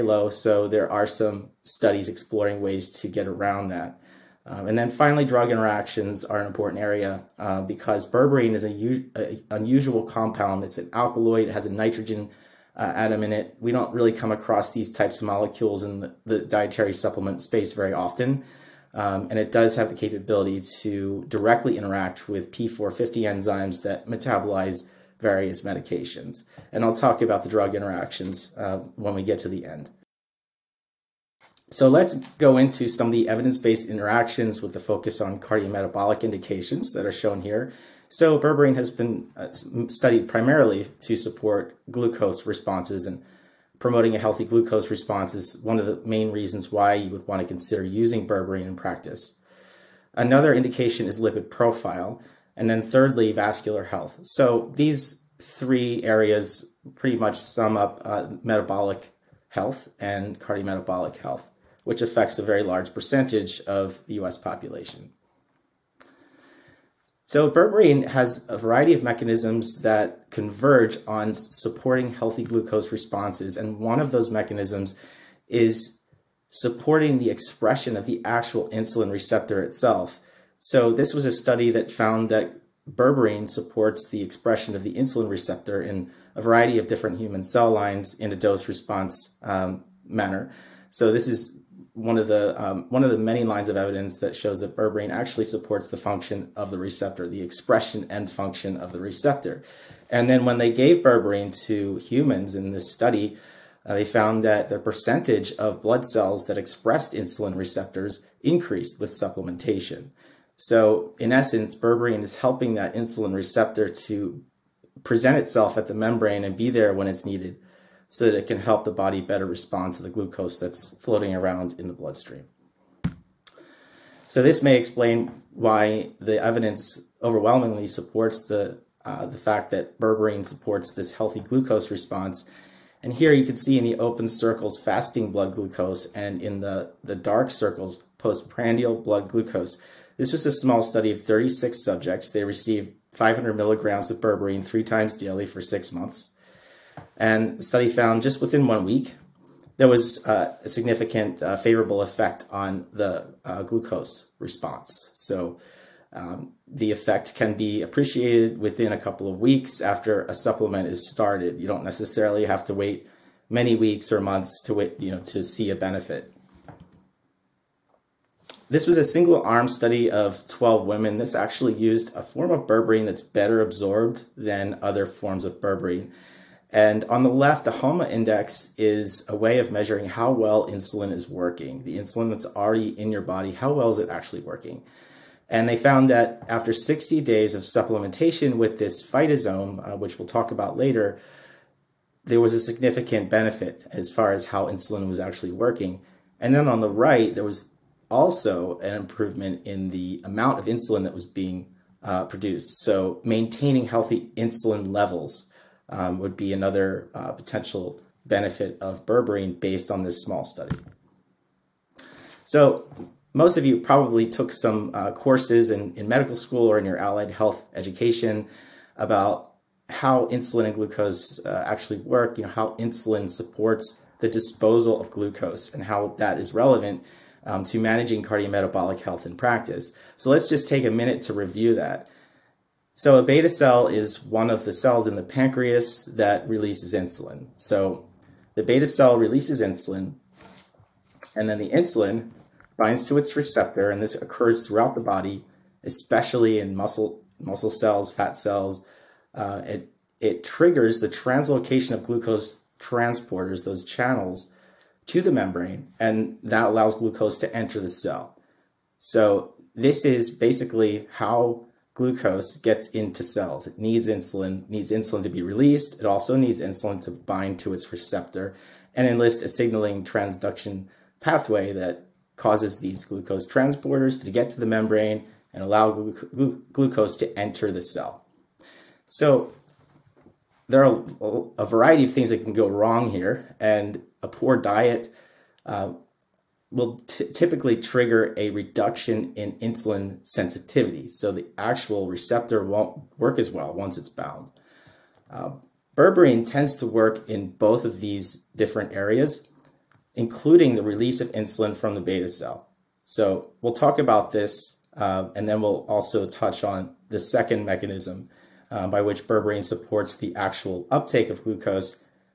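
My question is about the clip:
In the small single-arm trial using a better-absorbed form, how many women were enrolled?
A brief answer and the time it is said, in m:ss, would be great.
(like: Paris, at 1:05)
12, at 2:50.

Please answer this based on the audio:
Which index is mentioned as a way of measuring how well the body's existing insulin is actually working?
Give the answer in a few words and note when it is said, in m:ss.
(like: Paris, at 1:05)
HOMA index, at 2:57.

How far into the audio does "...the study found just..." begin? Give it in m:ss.
2:27.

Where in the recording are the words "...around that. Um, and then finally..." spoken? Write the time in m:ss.
0:03.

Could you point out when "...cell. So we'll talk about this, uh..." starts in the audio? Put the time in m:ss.
5:02.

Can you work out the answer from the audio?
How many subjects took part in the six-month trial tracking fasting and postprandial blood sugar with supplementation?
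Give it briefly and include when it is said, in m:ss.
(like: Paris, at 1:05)
36, at 2:21.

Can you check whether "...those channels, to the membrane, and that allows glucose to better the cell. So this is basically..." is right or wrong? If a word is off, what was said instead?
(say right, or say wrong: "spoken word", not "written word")
wrong: "enter", not "better".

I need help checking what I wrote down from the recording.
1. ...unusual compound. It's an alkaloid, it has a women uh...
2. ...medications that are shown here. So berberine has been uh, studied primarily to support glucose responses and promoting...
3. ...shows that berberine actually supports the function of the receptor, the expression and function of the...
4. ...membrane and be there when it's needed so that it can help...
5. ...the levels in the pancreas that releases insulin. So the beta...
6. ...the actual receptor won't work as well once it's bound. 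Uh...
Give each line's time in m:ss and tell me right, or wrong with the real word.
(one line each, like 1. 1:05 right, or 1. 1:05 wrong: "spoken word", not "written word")
1. 0:09 wrong: "nitrogen", not "women"
2. 0:36 wrong: "indications", not "medications"
3. 1:34 right
4. 1:55 right
5. 3:54 wrong: "cells", not "levels"
6. 4:51 right.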